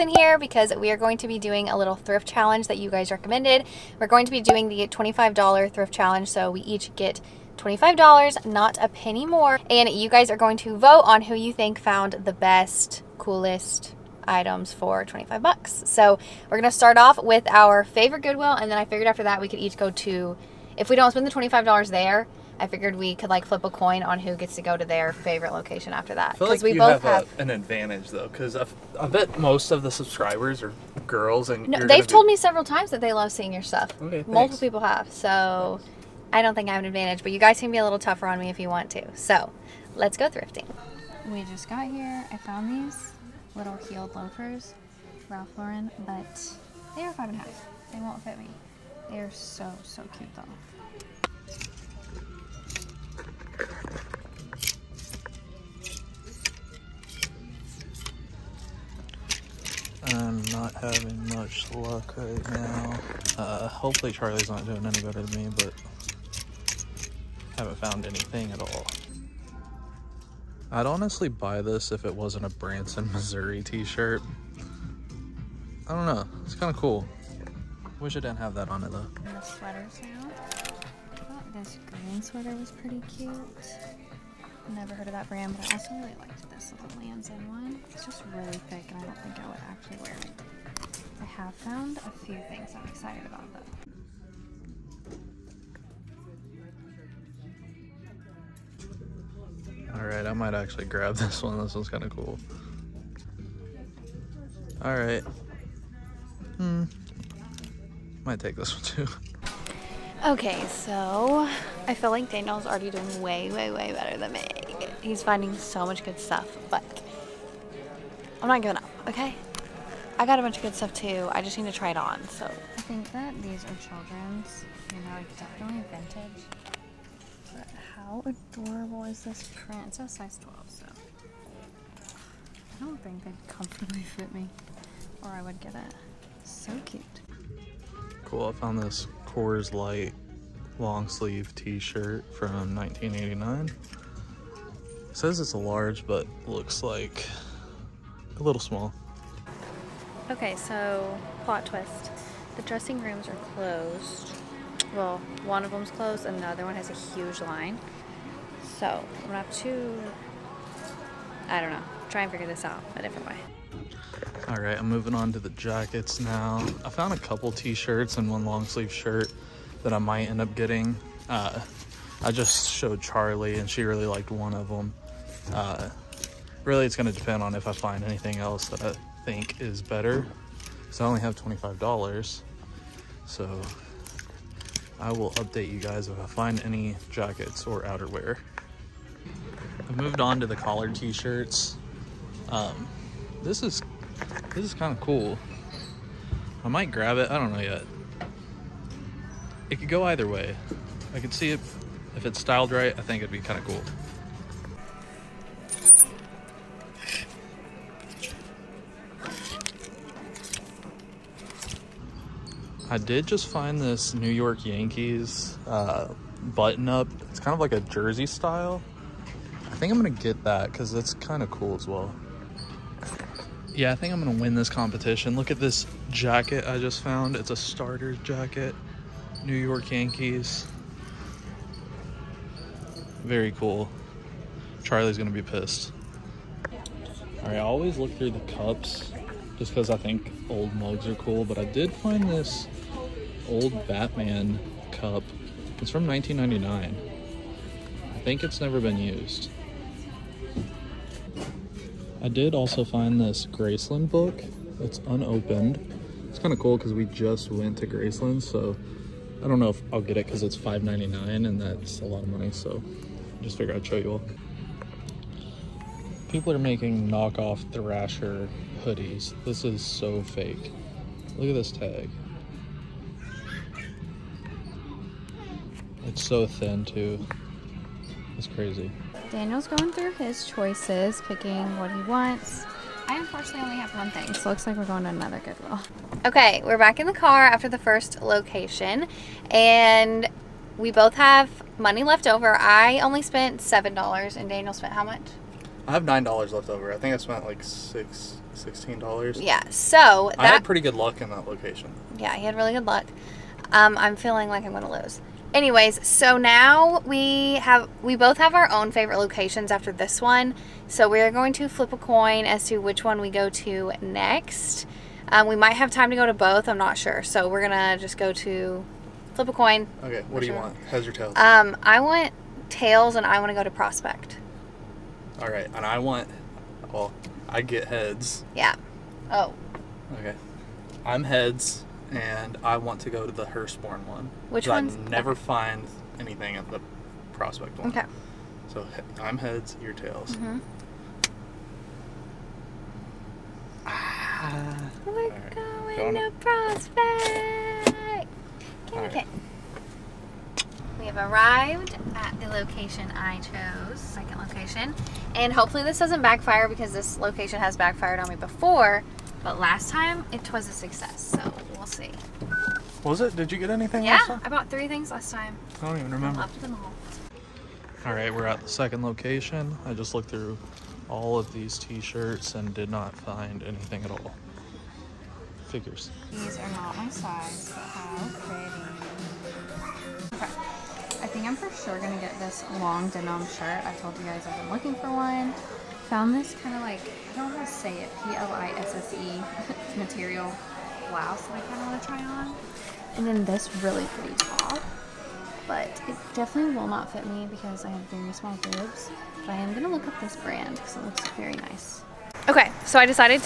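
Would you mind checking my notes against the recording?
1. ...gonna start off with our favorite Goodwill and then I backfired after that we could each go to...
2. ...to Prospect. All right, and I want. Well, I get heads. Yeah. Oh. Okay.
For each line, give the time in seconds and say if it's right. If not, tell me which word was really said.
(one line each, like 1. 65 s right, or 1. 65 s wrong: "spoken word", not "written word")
1. 16 s wrong: "figured", not "backfired"
2. 323 s right.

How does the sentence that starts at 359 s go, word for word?
But last time, it was a success, so we'll see.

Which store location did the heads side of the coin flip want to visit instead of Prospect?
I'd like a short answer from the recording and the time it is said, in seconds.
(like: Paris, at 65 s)
Hurstbourne, at 333 s.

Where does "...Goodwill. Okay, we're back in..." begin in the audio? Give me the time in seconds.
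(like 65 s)
285 s.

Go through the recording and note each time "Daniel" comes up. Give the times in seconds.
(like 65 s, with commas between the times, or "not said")
112 s, 279 s, 294 s.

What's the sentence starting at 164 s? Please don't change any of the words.
All right, I'm moving on to the jackets now.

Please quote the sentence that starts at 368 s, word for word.
All right, we're at the second location.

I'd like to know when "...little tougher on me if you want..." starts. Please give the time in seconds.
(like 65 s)
37 s.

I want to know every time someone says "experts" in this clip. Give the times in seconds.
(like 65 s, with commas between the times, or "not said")
not said.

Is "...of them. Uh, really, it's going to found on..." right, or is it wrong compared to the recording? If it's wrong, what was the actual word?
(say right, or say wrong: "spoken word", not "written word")
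wrong: "depend", not "found".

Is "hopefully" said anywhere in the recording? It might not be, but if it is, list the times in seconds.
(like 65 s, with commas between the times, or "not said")
63 s, 355 s.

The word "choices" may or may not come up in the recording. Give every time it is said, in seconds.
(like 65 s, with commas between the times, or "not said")
280 s.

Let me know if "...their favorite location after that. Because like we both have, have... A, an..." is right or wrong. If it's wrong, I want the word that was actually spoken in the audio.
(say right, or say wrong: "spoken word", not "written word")
right.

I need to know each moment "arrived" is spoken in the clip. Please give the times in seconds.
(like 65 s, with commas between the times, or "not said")
351 s.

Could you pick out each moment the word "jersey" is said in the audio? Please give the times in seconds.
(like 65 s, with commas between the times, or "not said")
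217 s.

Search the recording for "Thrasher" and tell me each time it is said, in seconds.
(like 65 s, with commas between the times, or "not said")
267 s.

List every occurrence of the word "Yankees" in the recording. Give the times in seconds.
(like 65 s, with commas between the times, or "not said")
214 s, 229 s.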